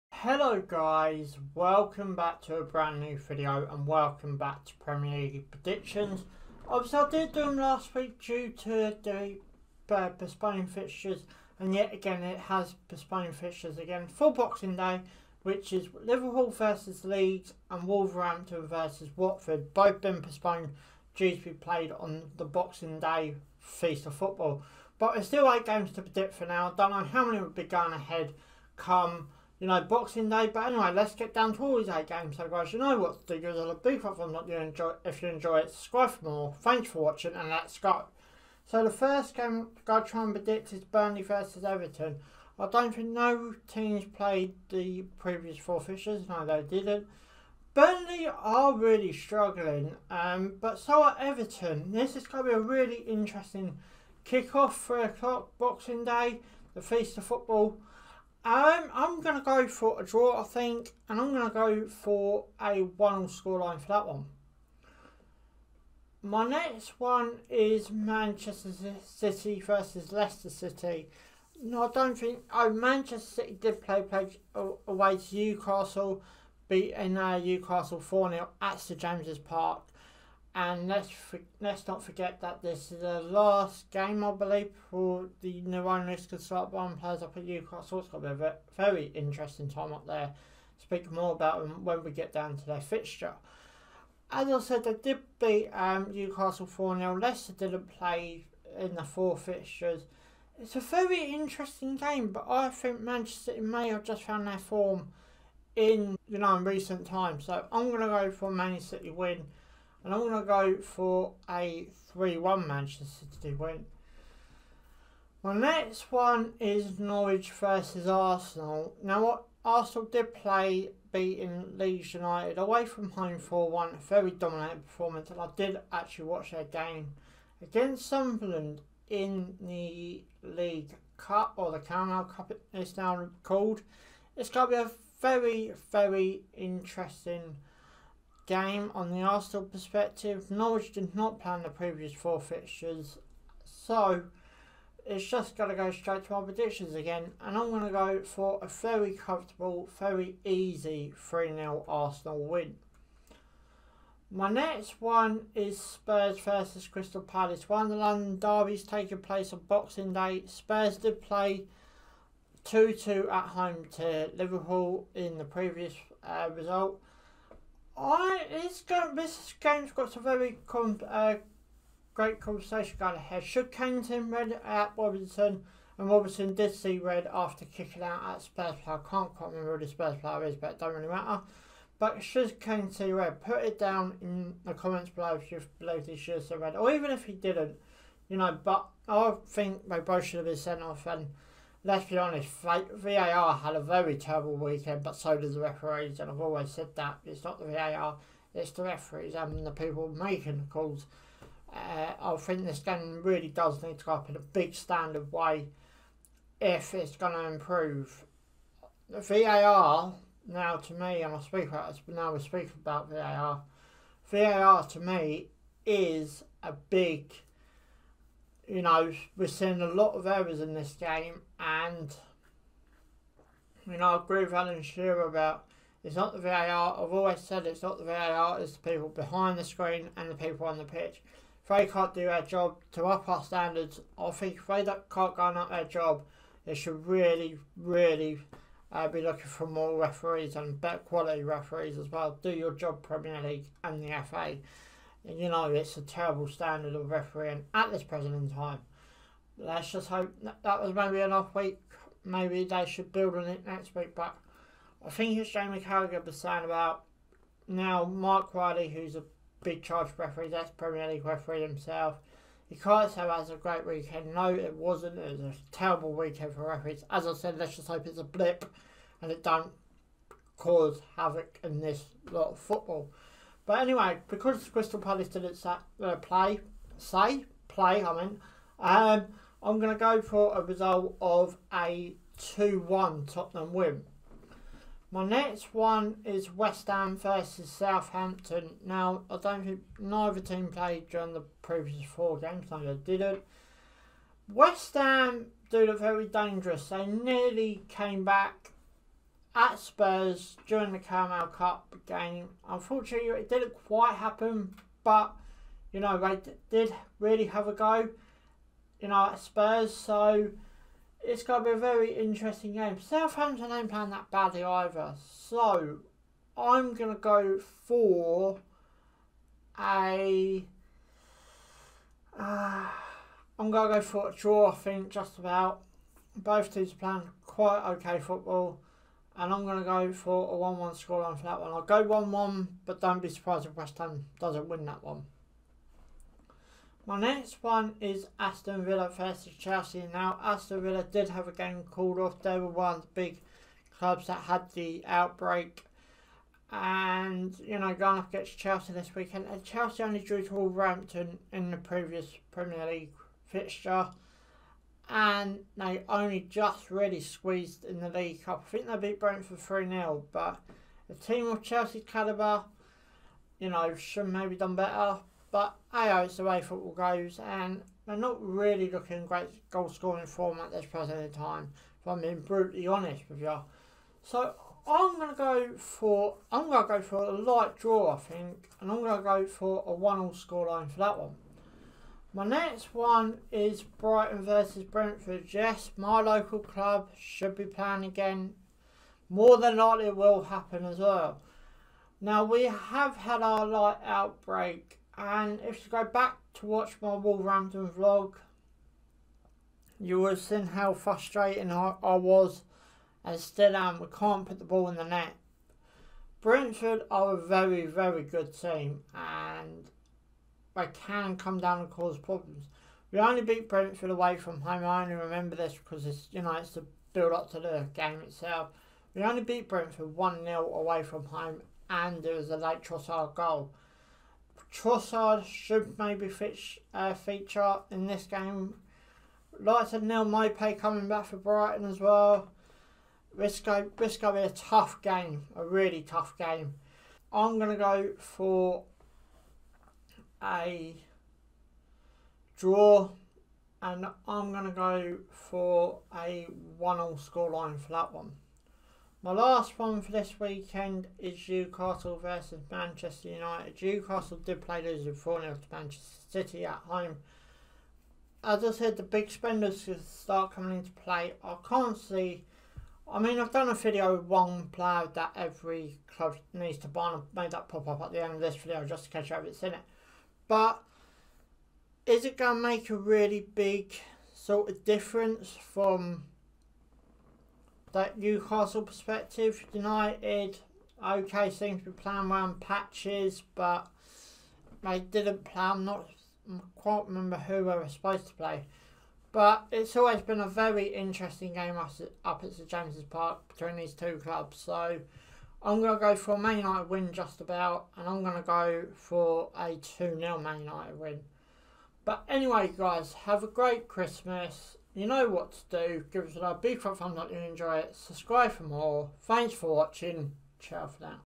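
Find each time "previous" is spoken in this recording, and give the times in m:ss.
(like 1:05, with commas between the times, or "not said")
0:45, 2:21, 2:45, 4:51, 5:51.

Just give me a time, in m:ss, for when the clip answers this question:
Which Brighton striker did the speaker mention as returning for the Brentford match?
7:10.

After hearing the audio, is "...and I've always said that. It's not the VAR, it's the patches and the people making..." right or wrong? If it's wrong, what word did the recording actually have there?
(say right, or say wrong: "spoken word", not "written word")
wrong: "referees", not "patches".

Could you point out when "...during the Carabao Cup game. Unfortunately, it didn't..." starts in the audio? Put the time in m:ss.
5:00.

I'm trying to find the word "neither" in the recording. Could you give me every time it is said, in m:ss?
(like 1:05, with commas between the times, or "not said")
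4:49.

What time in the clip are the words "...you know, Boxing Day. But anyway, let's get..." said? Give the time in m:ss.
0:29.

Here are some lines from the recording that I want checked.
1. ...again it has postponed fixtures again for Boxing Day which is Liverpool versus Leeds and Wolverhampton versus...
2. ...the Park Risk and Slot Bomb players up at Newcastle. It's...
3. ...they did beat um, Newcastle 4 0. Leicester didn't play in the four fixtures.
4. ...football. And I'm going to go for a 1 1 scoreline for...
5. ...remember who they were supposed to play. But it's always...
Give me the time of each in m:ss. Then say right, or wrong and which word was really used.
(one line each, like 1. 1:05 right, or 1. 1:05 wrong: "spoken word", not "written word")
1. 0:11 right
2. 1:25 wrong: "Nirvana", not "Park"
3. 1:34 right
4. 5:28 right
5. 8:07 right.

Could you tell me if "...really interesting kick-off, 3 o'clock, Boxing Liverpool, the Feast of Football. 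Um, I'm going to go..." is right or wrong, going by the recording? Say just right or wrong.
wrong.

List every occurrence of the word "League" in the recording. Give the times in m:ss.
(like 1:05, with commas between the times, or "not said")
0:05, 2:10, 4:03, 4:21, 5:52, 5:58.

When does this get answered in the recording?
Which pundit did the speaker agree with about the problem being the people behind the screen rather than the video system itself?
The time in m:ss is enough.
3:44.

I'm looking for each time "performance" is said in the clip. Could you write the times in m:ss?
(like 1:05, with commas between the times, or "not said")
2:04.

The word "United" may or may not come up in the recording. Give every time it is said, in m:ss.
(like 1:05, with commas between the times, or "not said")
2:02, 7:33, 7:59, 8:16, 8:20.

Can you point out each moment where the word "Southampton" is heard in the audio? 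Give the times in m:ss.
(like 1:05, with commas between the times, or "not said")
4:47, 5:13.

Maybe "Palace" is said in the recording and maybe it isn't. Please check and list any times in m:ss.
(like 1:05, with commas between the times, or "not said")
2:37, 4:34.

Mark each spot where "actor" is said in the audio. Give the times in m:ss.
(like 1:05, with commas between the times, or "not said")
not said.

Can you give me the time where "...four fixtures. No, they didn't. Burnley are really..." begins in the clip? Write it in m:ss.
0:45.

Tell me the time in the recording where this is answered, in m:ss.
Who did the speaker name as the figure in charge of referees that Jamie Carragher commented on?
4:18.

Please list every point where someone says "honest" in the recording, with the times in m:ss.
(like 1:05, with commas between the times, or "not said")
3:12, 6:12.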